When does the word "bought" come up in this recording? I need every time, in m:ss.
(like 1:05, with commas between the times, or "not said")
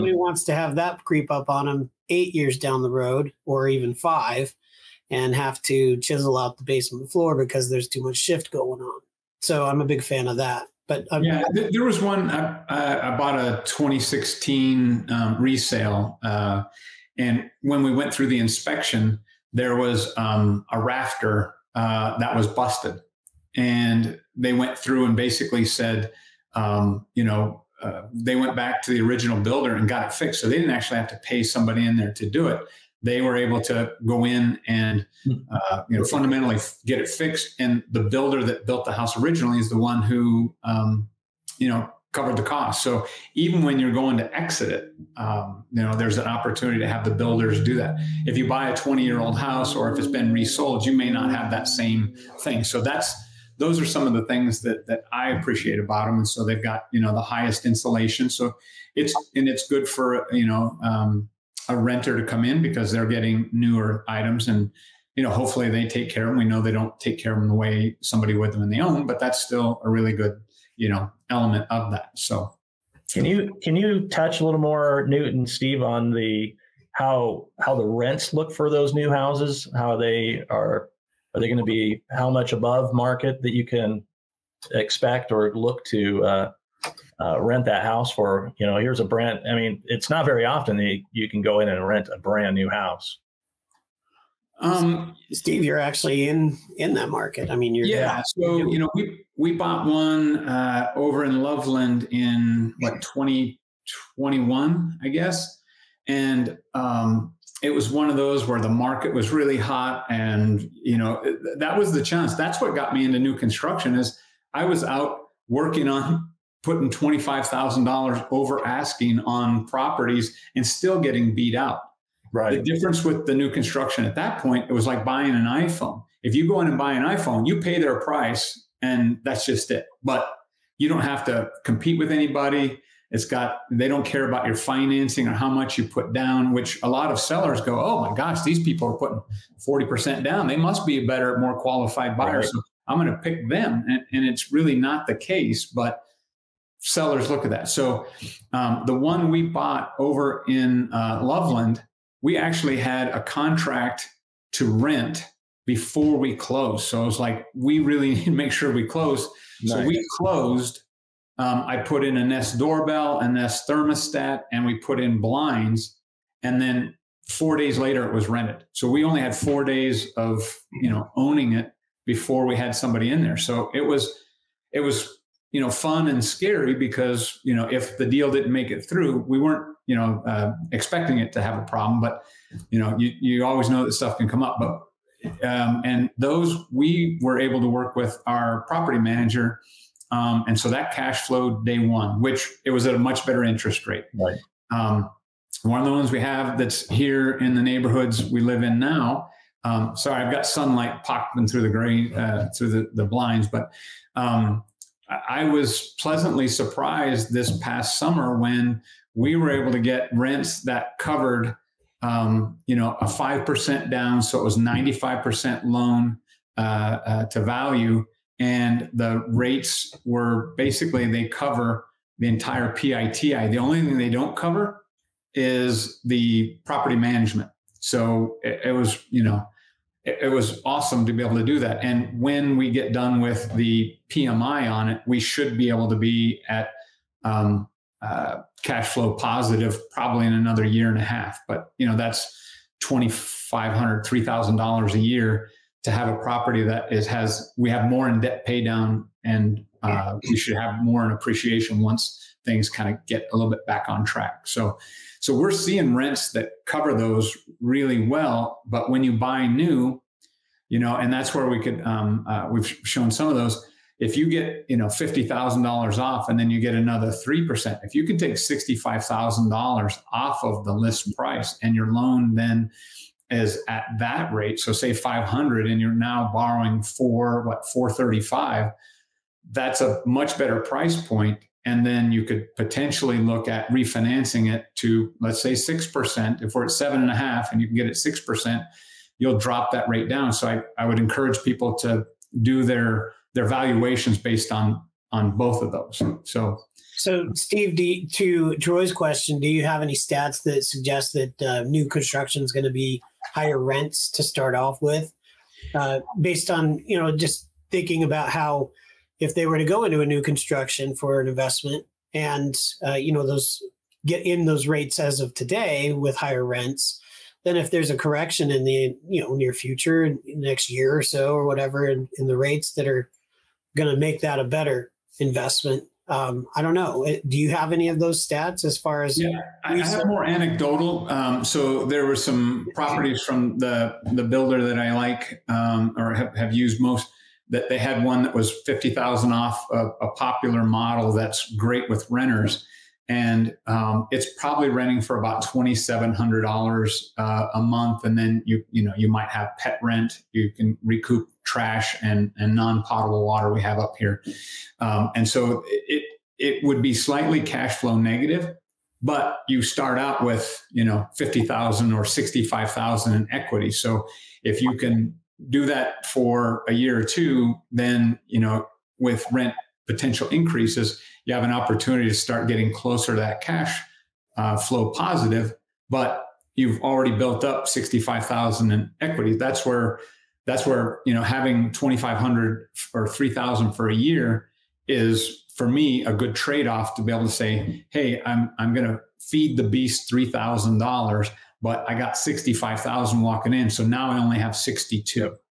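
0:13, 1:39, 2:29.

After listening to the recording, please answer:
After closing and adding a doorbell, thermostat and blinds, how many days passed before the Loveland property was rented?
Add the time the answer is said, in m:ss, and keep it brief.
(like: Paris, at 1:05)
4 days, at 2:47.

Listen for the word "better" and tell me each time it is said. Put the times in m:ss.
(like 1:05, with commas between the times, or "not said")
2:21, 3:13, 4:40, 5:24.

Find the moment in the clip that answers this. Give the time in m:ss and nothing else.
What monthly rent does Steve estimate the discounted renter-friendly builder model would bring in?
5:45.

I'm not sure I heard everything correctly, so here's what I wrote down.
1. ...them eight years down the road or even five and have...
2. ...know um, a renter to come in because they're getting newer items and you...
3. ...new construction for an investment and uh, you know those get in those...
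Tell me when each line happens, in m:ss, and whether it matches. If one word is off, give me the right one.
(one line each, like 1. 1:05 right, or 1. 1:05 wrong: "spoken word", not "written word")
1. 0:01 right
2. 1:00 right
3. 5:10 right.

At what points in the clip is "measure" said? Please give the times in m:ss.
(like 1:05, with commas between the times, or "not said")
not said.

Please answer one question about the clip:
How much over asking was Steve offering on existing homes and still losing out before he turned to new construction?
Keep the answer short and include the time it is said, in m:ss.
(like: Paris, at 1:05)
$25,000, at 1:56.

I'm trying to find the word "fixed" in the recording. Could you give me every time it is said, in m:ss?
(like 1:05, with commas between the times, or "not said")
0:30, 0:37.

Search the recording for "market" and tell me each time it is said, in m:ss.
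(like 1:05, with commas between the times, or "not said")
1:22, 1:37, 1:48.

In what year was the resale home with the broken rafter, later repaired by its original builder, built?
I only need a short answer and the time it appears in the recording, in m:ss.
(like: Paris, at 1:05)
2016, at 0:13.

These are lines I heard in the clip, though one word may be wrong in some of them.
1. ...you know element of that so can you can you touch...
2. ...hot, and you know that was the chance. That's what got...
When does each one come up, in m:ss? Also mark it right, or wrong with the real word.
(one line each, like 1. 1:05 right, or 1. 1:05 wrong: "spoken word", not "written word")
1. 1:10 right
2. 1:49 right.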